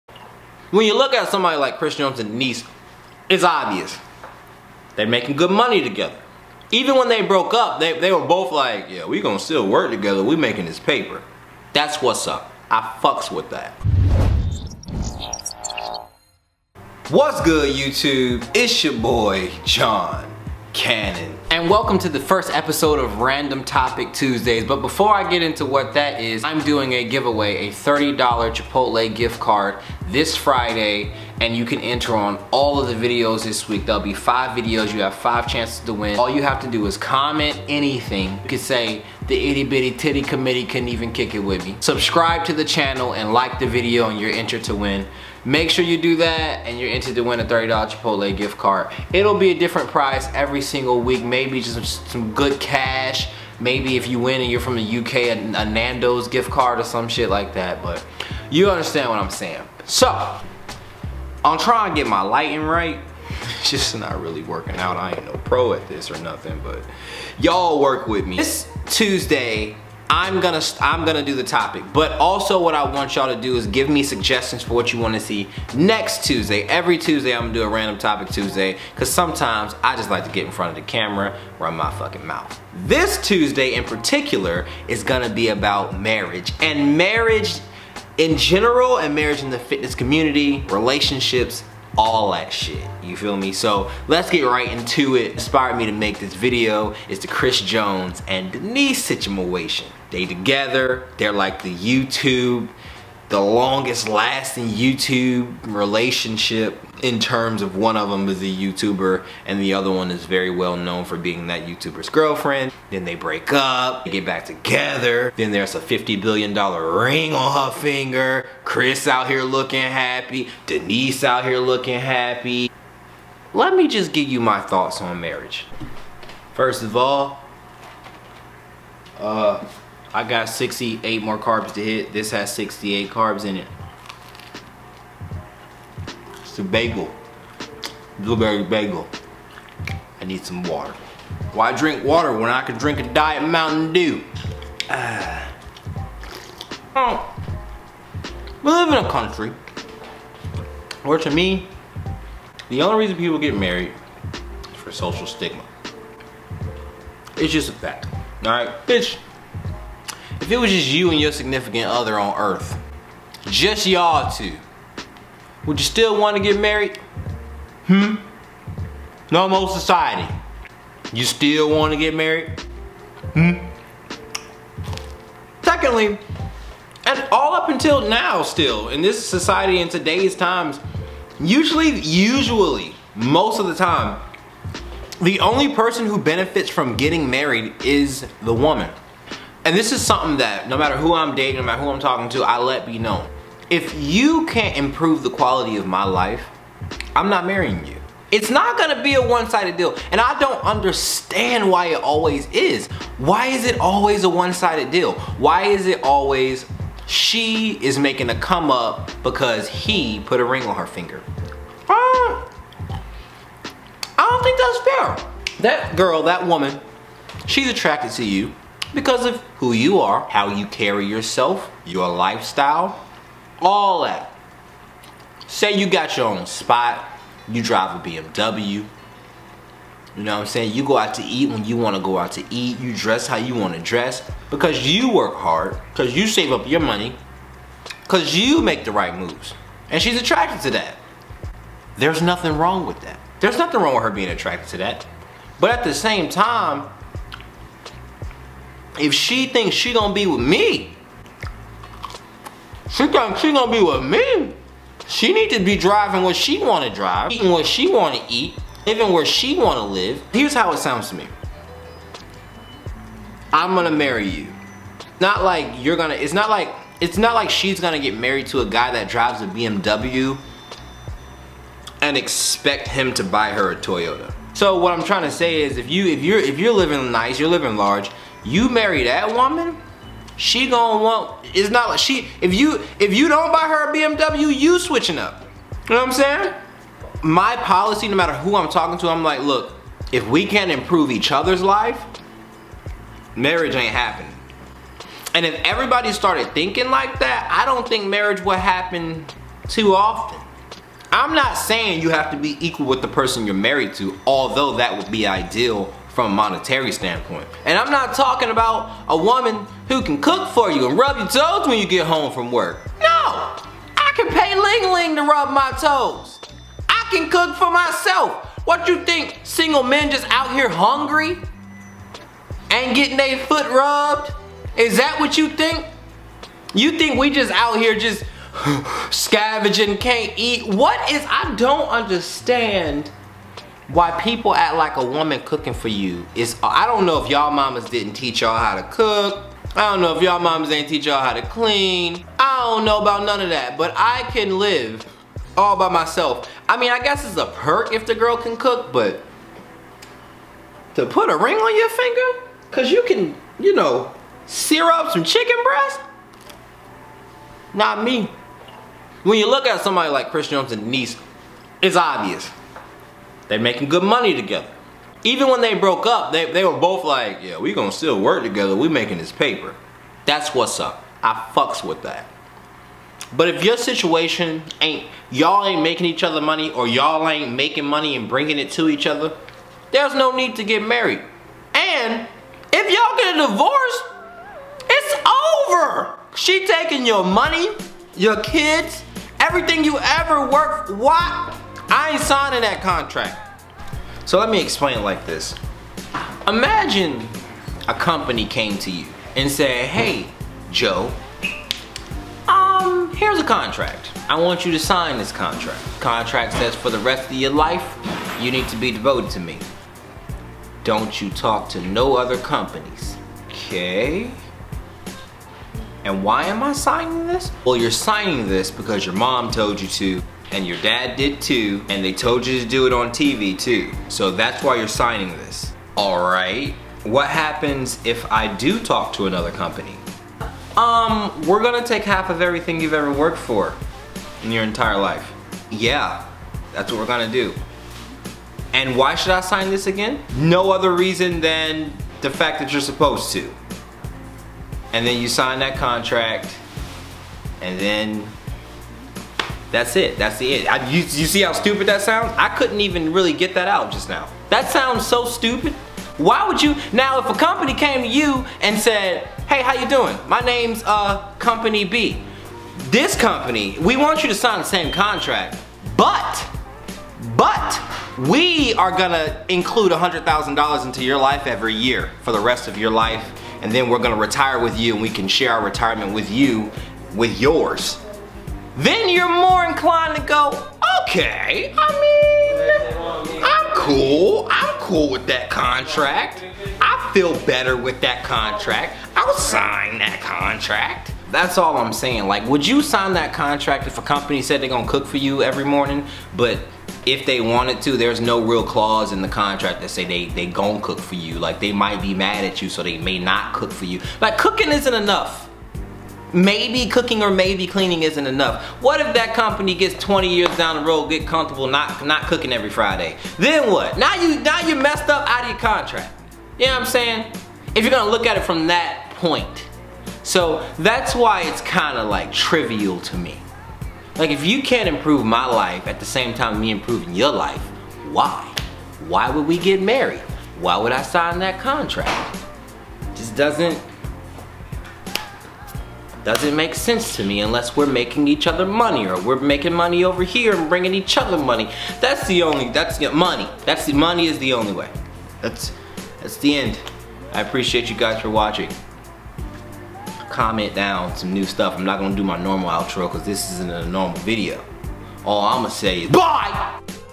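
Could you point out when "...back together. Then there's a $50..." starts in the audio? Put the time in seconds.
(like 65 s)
114 s.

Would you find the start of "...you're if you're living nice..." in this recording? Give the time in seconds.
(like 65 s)
276 s.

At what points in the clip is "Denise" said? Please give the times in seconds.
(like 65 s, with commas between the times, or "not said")
2 s, 98 s, 120 s, 360 s.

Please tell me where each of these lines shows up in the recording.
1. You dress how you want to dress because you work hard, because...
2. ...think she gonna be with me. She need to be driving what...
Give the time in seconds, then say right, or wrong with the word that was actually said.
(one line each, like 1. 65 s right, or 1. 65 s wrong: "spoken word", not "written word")
1. 232 s right
2. 253 s right.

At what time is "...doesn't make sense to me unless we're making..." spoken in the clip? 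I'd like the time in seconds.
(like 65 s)
536 s.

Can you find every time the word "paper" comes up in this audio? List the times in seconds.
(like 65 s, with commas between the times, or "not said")
10 s, 369 s.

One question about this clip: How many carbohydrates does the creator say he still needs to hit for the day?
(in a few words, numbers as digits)
68.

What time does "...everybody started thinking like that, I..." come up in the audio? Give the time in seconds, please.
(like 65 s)
295 s.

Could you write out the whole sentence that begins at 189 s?
And this is something that no matter who I'm dating, no matter who I'm talking to, I let be known.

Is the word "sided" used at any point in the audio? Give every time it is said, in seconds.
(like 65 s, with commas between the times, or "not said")
199 s, 204 s.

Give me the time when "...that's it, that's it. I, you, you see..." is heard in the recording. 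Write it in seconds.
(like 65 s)
449 s.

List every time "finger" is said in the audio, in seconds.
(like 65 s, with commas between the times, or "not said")
117 s, 210 s, 351 s.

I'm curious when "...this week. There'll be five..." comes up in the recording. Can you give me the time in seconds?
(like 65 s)
33 s.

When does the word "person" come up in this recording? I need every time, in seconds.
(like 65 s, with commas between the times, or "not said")
185 s, 303 s.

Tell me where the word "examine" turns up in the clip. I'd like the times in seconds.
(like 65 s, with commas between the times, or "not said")
not said.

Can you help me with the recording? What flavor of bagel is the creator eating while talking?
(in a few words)
Blueberry.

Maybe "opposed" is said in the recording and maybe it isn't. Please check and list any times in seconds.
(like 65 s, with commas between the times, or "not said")
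not said.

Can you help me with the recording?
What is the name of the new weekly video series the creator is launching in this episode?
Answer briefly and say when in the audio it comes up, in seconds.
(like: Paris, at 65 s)
Random Topic Tuesdays, at 23 s.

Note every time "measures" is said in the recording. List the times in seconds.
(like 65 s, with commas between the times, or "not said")
not said.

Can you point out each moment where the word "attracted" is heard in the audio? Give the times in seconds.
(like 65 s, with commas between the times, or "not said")
217 s, 240 s, 244 s.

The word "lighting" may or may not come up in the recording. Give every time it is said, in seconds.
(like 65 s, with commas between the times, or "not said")
62 s.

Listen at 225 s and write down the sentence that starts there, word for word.
Say you got your own spot, you drive a BMW.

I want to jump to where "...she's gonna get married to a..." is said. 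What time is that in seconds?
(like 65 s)
267 s.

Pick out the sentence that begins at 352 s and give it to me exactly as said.
Cause you can, you know, sear up some chicken breast?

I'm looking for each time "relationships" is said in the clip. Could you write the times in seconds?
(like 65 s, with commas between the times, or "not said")
90 s, 105 s.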